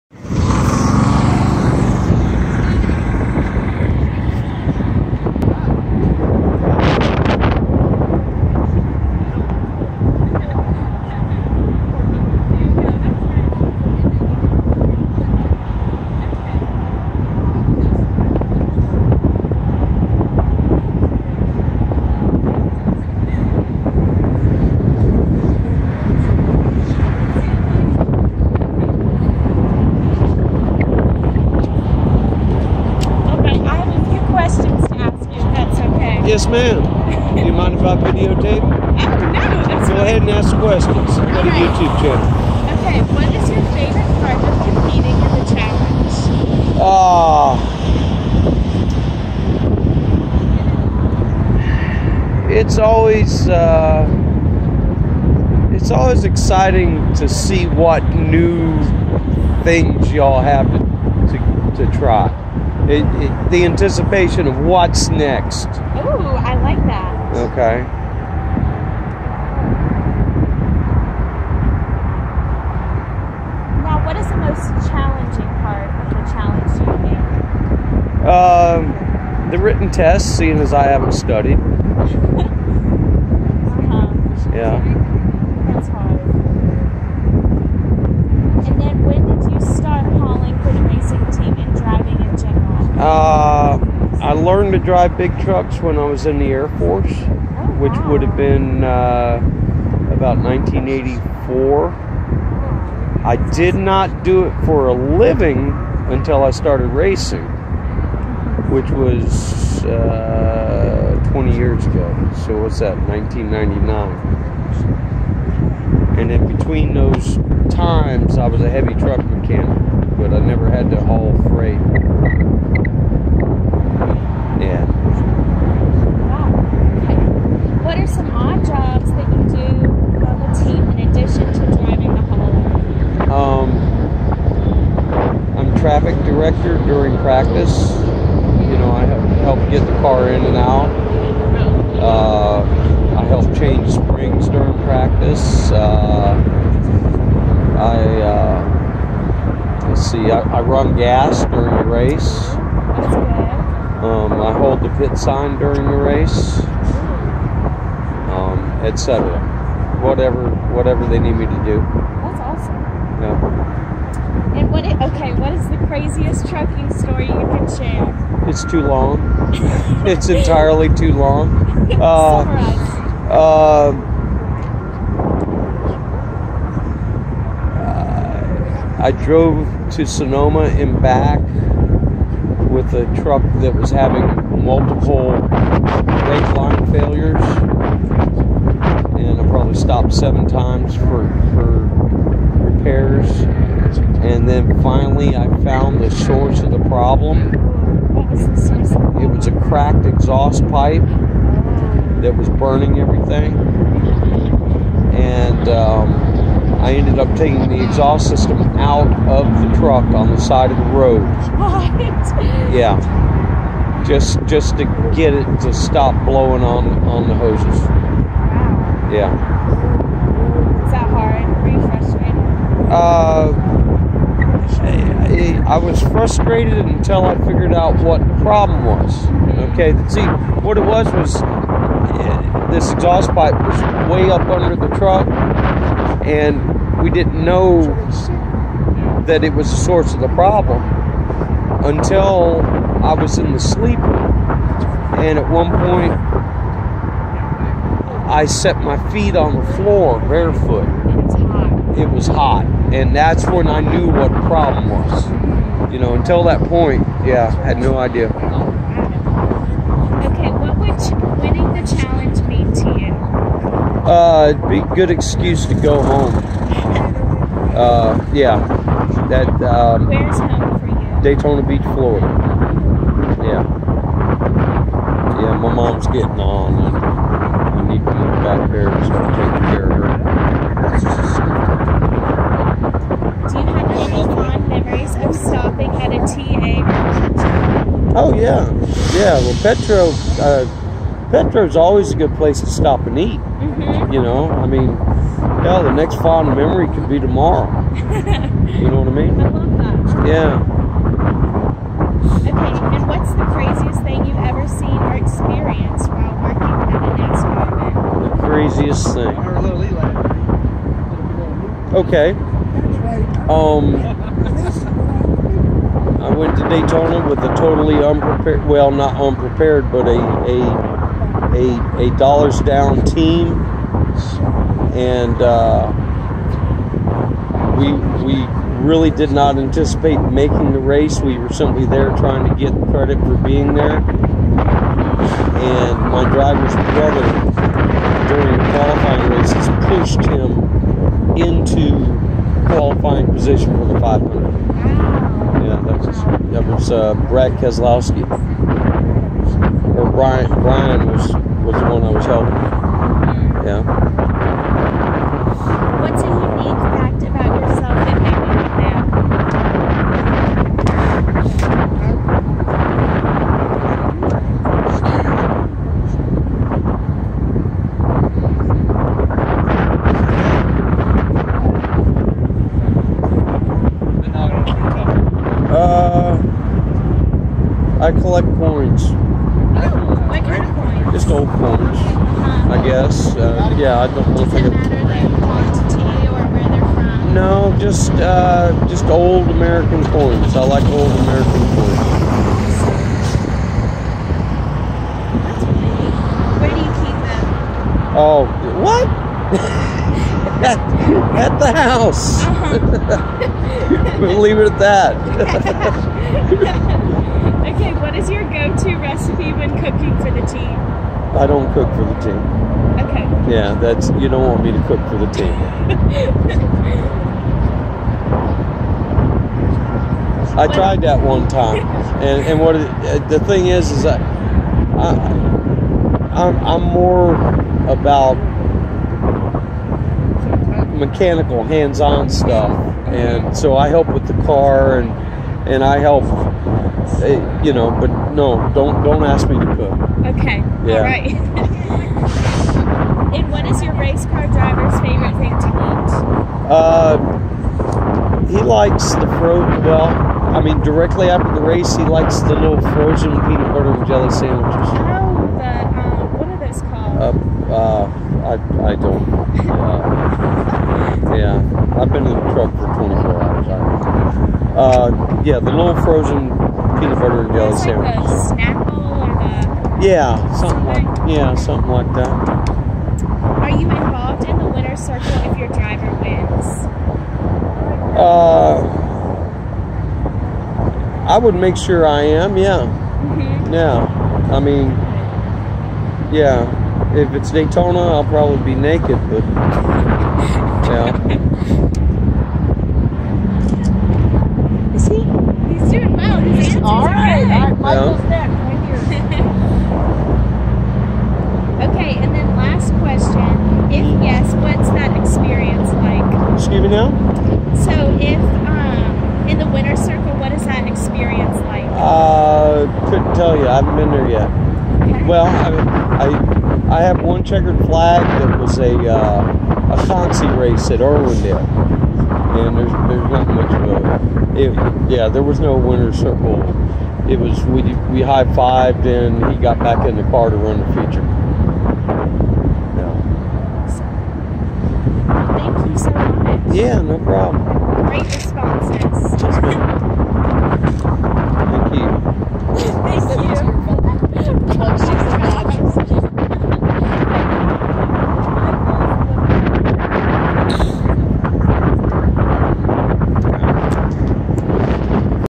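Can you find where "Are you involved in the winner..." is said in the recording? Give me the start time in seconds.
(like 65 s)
473 s.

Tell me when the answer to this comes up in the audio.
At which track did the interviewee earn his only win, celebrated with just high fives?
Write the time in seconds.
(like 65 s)
521 s.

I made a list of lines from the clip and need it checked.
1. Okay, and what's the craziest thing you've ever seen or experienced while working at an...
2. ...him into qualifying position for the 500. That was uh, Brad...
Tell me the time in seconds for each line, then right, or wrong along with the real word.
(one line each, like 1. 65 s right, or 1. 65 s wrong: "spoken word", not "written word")
1. 302 s right
2. 340 s right.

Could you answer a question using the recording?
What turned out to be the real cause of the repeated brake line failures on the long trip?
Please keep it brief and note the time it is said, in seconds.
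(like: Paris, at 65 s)
cracked exhaust pipe, at 199 s.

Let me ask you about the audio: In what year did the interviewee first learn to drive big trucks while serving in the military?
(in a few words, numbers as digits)
1984.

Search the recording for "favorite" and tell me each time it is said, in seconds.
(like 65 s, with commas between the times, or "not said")
43 s, 445 s.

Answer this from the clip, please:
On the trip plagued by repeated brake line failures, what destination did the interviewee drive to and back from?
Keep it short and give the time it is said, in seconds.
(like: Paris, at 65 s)
Sonoma, at 180 s.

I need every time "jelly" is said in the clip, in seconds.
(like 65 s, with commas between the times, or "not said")
454 s, 467 s.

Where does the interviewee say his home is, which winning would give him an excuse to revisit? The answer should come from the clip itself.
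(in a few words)
Daytona Beach, Florida.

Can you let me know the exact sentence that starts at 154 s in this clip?
Um, I hold the pit sign during the race, um, etc.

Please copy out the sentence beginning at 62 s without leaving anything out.
It, it, the anticipation of what's next.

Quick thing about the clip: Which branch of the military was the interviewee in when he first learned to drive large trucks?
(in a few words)
Air Force.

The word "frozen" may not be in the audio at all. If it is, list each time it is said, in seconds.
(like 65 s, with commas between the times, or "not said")
452 s, 466 s.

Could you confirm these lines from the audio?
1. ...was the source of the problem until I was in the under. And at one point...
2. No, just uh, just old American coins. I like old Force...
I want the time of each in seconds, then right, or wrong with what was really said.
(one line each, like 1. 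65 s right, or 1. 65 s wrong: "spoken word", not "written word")
1. 239 s wrong: "sleeper", not "under"
2. 387 s wrong: "American", not "Force".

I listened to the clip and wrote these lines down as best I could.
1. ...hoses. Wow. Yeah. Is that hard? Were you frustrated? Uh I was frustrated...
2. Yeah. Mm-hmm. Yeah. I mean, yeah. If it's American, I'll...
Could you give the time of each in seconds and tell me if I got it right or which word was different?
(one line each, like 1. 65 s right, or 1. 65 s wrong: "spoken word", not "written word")
1. 217 s right
2. 482 s wrong: "Daytona", not "American".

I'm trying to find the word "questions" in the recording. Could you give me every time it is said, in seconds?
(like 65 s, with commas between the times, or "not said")
40 s, 502 s.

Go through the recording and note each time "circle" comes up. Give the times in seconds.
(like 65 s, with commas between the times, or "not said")
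474 s, 509 s, 526 s.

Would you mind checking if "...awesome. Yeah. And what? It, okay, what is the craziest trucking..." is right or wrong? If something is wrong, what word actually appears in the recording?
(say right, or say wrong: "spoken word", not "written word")
right.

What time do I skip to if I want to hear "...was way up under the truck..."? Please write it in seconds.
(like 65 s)
233 s.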